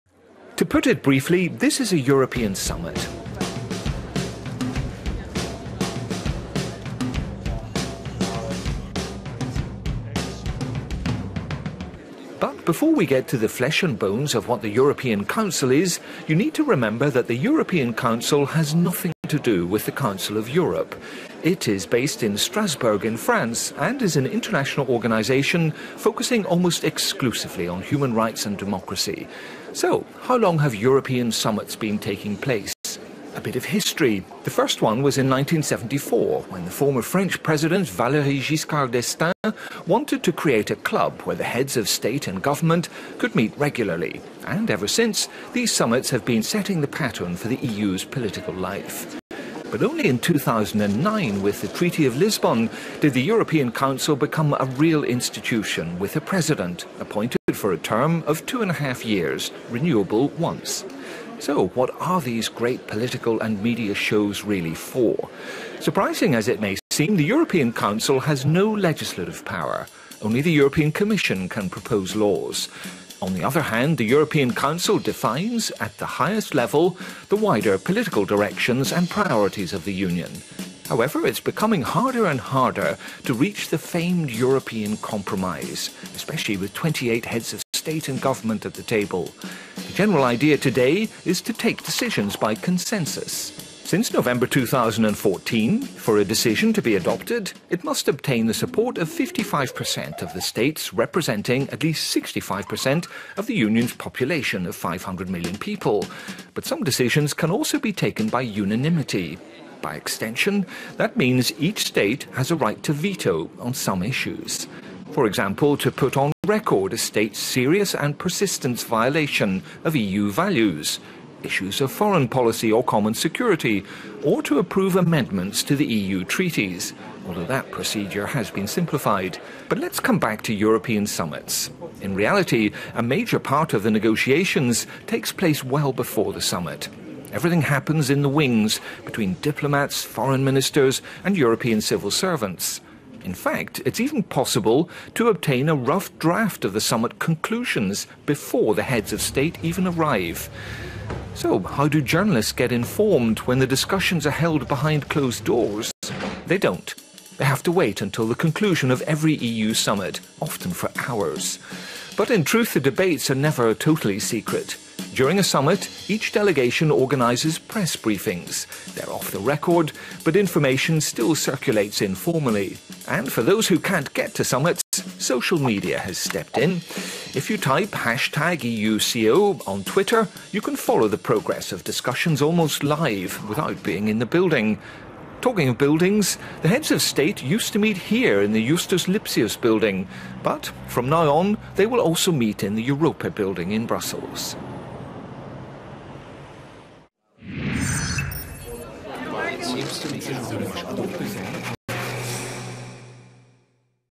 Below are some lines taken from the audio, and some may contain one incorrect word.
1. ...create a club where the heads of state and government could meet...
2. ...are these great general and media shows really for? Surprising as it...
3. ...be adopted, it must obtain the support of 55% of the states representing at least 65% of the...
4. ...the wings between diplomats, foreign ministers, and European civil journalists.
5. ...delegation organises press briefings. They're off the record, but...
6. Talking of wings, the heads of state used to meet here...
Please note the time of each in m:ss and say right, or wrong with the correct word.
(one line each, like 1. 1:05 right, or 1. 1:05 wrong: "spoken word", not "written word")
1. 0:40 right
2. 1:02 wrong: "political", not "general"
3. 1:36 right
4. 2:18 wrong: "servants", not "journalists"
5. 2:46 right
6. 3:05 wrong: "buildings", not "wings".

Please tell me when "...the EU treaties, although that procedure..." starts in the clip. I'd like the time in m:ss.
2:05.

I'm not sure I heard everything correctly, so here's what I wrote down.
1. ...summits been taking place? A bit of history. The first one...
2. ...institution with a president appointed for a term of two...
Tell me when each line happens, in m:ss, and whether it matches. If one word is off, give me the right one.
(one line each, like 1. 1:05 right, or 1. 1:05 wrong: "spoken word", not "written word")
1. 0:31 right
2. 0:55 right.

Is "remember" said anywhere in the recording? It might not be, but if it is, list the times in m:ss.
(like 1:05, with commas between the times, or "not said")
0:16.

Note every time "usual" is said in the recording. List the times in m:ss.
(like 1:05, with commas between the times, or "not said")
not said.